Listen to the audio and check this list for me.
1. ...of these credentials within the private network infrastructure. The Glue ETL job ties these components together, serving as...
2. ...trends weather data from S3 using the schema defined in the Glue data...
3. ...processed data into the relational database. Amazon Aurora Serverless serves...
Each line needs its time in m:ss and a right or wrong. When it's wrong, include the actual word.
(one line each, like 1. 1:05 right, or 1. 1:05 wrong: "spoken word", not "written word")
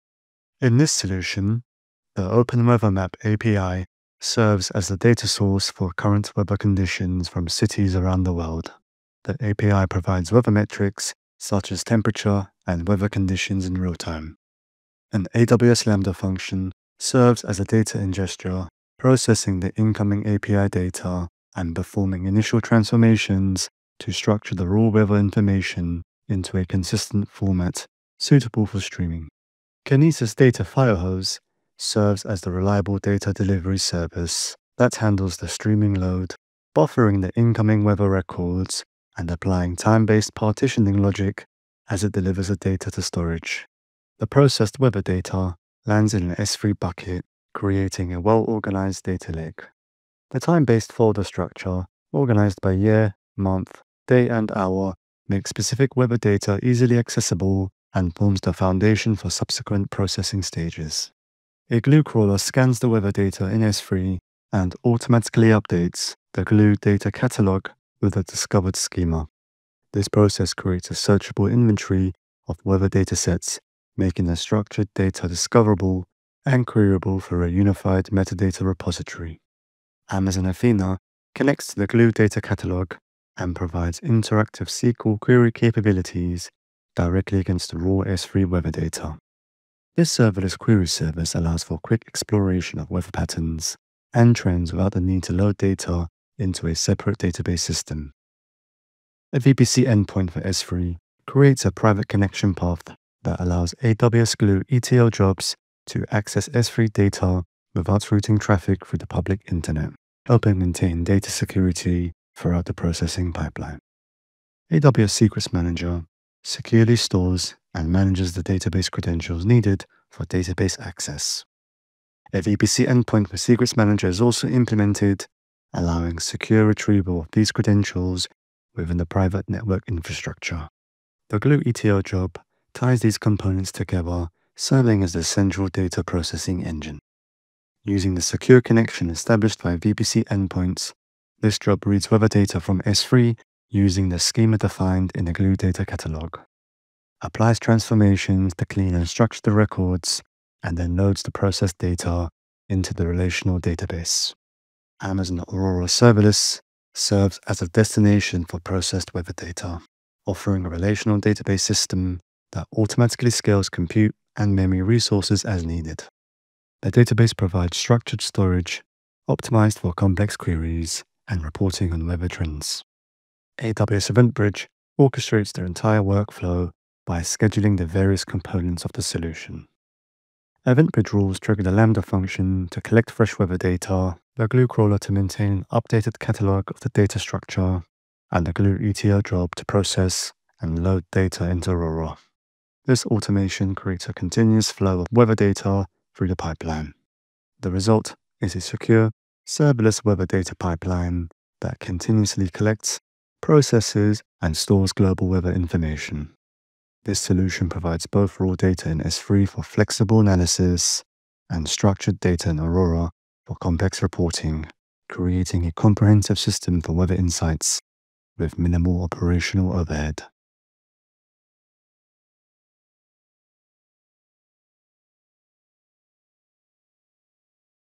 1. 2:07 right
2. 2:21 wrong: "reads", not "trends"
3. 2:31 right.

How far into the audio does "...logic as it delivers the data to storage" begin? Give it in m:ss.
0:41.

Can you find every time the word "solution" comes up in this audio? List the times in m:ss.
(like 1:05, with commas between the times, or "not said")
0:00, 2:59, 3:27.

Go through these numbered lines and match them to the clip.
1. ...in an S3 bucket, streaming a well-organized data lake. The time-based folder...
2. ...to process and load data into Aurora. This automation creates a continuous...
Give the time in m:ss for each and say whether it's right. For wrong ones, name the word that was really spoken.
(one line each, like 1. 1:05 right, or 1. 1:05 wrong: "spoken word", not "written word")
1. 0:46 wrong: "creating", not "streaming"
2. 3:09 right.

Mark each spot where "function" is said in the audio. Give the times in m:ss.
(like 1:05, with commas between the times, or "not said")
0:16, 3:02.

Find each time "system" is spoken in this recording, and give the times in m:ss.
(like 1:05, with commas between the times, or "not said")
1:37, 2:41, 3:36.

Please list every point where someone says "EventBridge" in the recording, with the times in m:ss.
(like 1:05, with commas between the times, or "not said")
2:54, 3:00.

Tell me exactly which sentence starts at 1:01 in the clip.
A glue crawler scans the weather data in S3 and automatically updates the glue data catalog with the discovered schema.